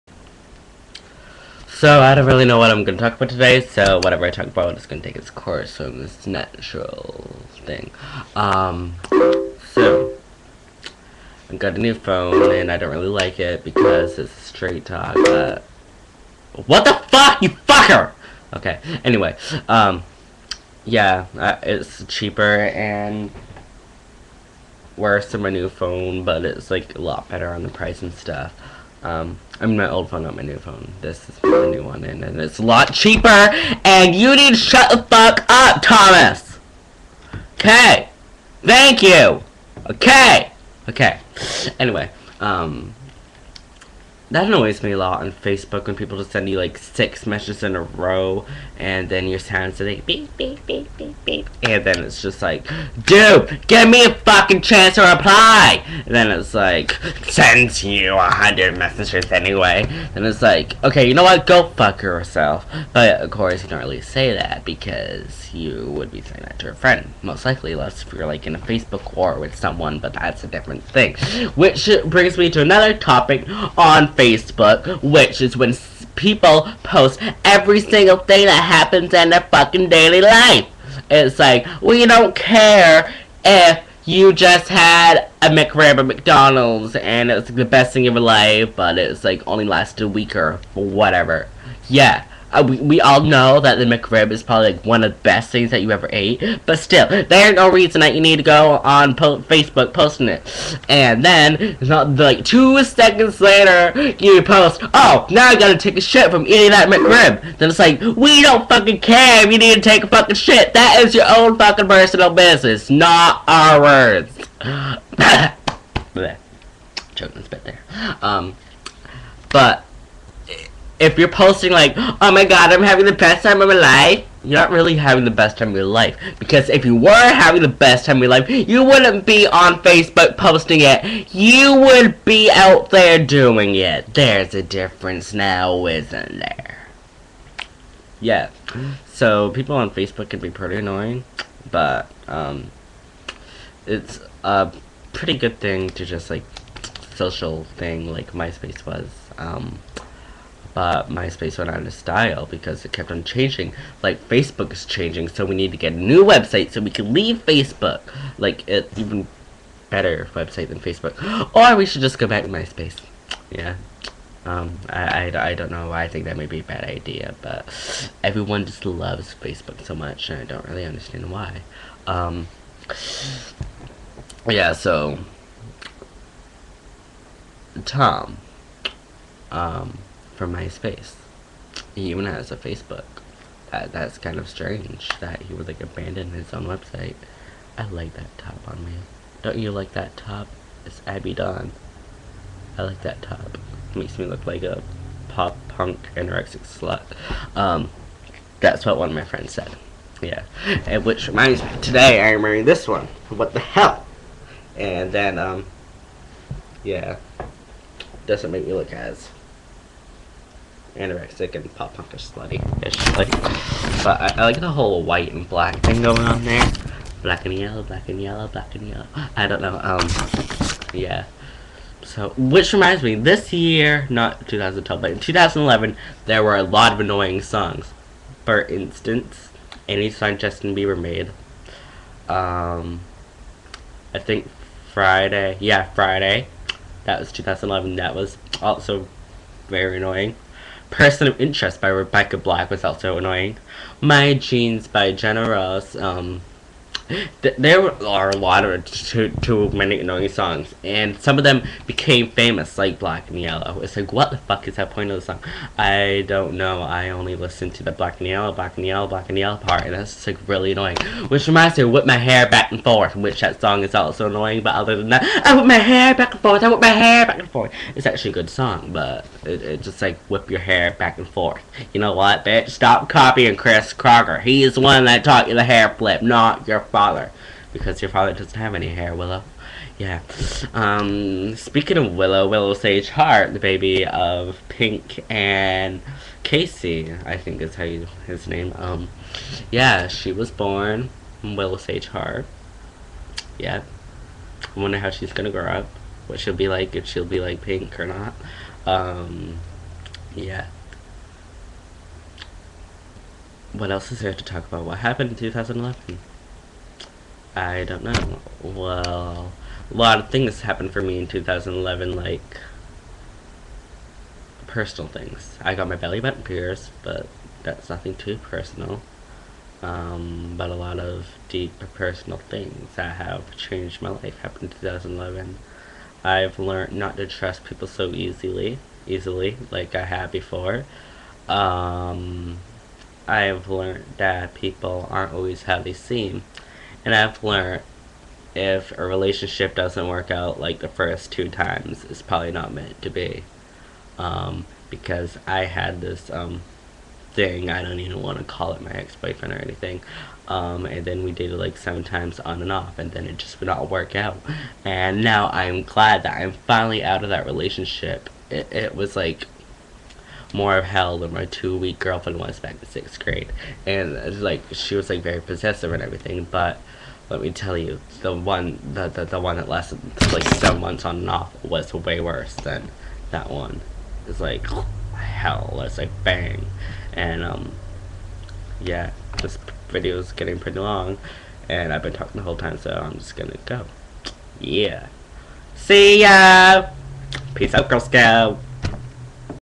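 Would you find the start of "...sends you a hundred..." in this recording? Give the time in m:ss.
0:57.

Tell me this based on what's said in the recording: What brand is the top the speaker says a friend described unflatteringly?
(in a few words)
Abbey Dawn.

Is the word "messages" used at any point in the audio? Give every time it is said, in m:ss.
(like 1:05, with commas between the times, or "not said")
0:47, 0:58.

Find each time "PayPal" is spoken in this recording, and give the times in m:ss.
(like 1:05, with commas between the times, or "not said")
not said.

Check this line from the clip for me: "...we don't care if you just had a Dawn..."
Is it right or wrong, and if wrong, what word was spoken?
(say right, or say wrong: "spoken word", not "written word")
wrong: "McRib", not "Dawn".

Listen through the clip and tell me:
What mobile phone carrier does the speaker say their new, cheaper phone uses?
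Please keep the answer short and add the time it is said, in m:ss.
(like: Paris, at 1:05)
Straight Talk, at 0:14.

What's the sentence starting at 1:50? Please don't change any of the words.
That is your own fucking personal business, not ours.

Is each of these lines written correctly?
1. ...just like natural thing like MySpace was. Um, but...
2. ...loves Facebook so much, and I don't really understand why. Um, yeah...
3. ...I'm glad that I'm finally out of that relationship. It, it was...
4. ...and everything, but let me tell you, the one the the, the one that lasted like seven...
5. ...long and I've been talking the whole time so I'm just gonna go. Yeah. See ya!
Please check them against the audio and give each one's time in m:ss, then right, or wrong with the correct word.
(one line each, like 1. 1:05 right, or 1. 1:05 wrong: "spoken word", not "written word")
1. 2:26 wrong: "social", not "natural"
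2. 2:48 right
3. 5:55 right
4. 6:05 right
5. 6:20 right.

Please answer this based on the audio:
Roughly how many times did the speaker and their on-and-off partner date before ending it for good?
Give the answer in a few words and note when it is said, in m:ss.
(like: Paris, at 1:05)
7, at 5:51.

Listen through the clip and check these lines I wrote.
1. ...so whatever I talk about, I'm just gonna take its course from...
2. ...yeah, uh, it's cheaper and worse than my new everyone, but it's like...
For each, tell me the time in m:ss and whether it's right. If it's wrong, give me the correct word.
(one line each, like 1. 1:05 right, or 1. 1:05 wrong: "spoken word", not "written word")
1. 0:03 right
2. 0:20 wrong: "phone", not "everyone".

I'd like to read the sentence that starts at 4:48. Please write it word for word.
Um, yeah, she was born Willow Sage Hart.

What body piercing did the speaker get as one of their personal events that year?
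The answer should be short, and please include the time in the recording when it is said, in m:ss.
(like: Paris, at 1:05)
Belly button, at 5:15.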